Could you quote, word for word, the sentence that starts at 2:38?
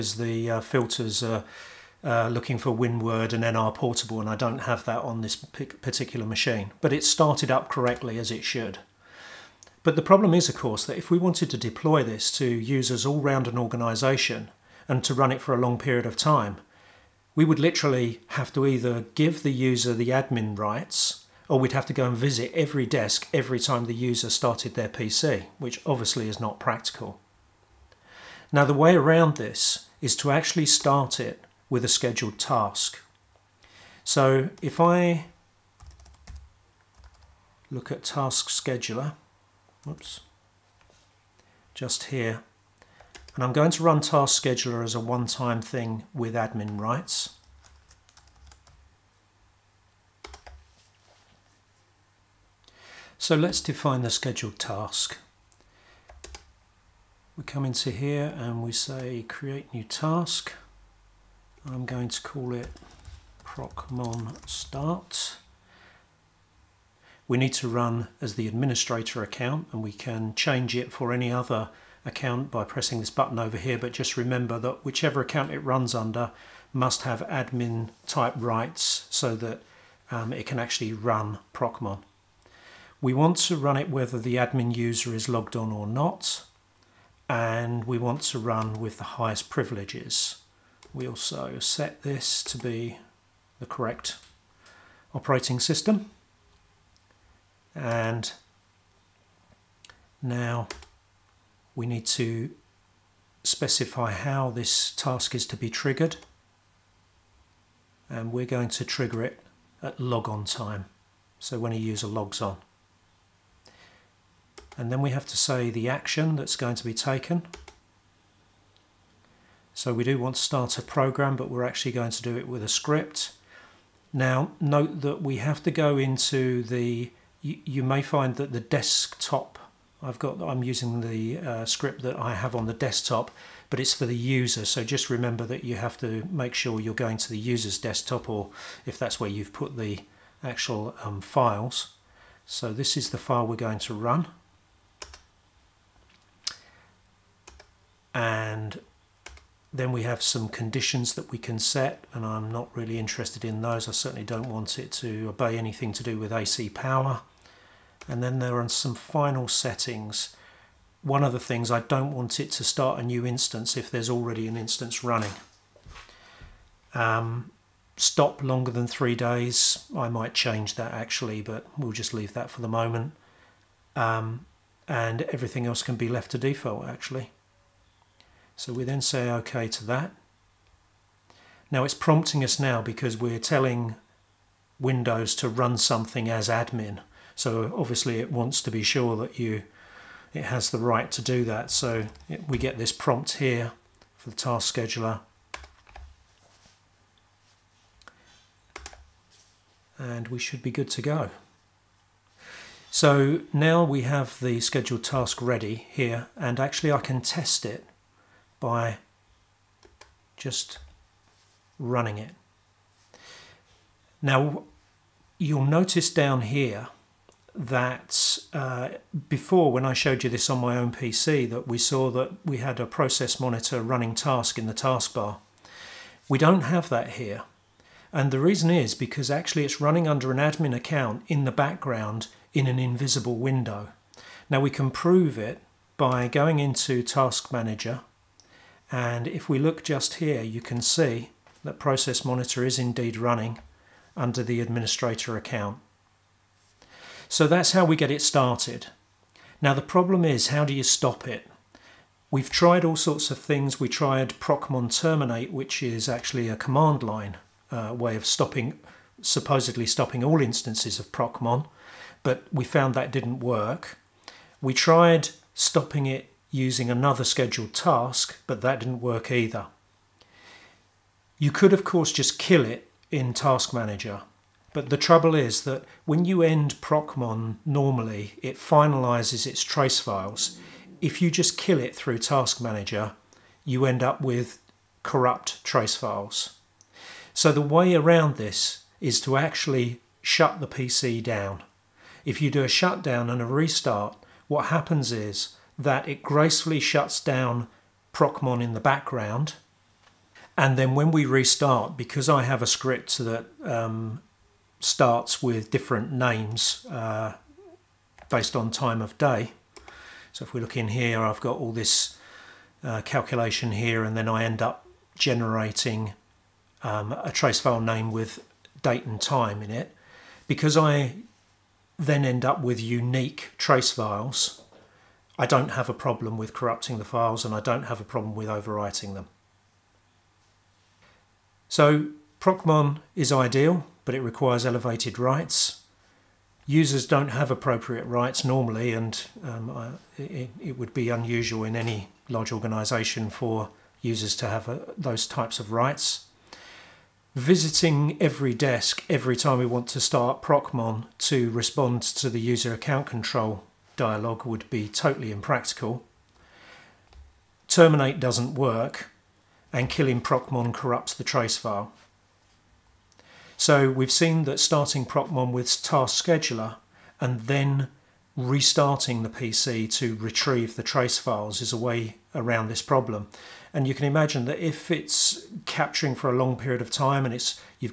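And then there are some final settings.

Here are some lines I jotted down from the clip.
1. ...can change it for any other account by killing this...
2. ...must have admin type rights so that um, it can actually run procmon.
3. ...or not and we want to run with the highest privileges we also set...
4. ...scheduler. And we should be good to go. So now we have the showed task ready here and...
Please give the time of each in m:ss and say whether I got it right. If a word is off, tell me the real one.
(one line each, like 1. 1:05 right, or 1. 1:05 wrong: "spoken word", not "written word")
1. 1:09 wrong: "pressing", not "killing"
2. 1:16 right
3. 1:25 right
4. 3:14 wrong: "scheduled", not "showed".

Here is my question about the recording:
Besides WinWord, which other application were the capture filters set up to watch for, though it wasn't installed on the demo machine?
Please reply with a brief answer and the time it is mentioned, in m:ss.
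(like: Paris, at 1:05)
NR Portable, at 0:03.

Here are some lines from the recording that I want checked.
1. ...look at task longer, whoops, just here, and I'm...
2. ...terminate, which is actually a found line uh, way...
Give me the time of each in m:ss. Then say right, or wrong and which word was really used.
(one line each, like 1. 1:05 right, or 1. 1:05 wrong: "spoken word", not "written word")
1. 0:37 wrong: "scheduler", not "longer"
2. 4:14 wrong: "command", not "found".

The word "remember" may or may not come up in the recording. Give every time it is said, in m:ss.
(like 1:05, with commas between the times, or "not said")
1:14, 2:15.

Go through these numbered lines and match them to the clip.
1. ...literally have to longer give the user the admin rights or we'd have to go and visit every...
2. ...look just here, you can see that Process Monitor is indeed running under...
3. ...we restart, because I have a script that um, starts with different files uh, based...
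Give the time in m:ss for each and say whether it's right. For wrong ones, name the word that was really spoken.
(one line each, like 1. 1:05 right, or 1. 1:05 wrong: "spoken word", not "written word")
1. 0:17 wrong: "either", not "longer"
2. 3:59 right
3. 5:01 wrong: "names", not "files".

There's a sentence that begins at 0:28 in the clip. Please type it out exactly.
Now, the way around this is to actually start it with a scheduled task.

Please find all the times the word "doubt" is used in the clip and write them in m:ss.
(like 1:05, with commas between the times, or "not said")
not said.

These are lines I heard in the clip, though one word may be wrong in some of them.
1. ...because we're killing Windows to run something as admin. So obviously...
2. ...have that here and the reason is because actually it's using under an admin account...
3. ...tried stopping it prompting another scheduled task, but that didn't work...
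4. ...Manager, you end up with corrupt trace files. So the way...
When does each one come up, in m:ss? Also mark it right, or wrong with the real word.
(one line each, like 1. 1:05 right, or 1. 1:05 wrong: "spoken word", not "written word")
1. 3:02 wrong: "telling", not "killing"
2. 3:46 wrong: "running", not "using"
3. 4:24 wrong: "using", not "prompting"
4. 4:42 right.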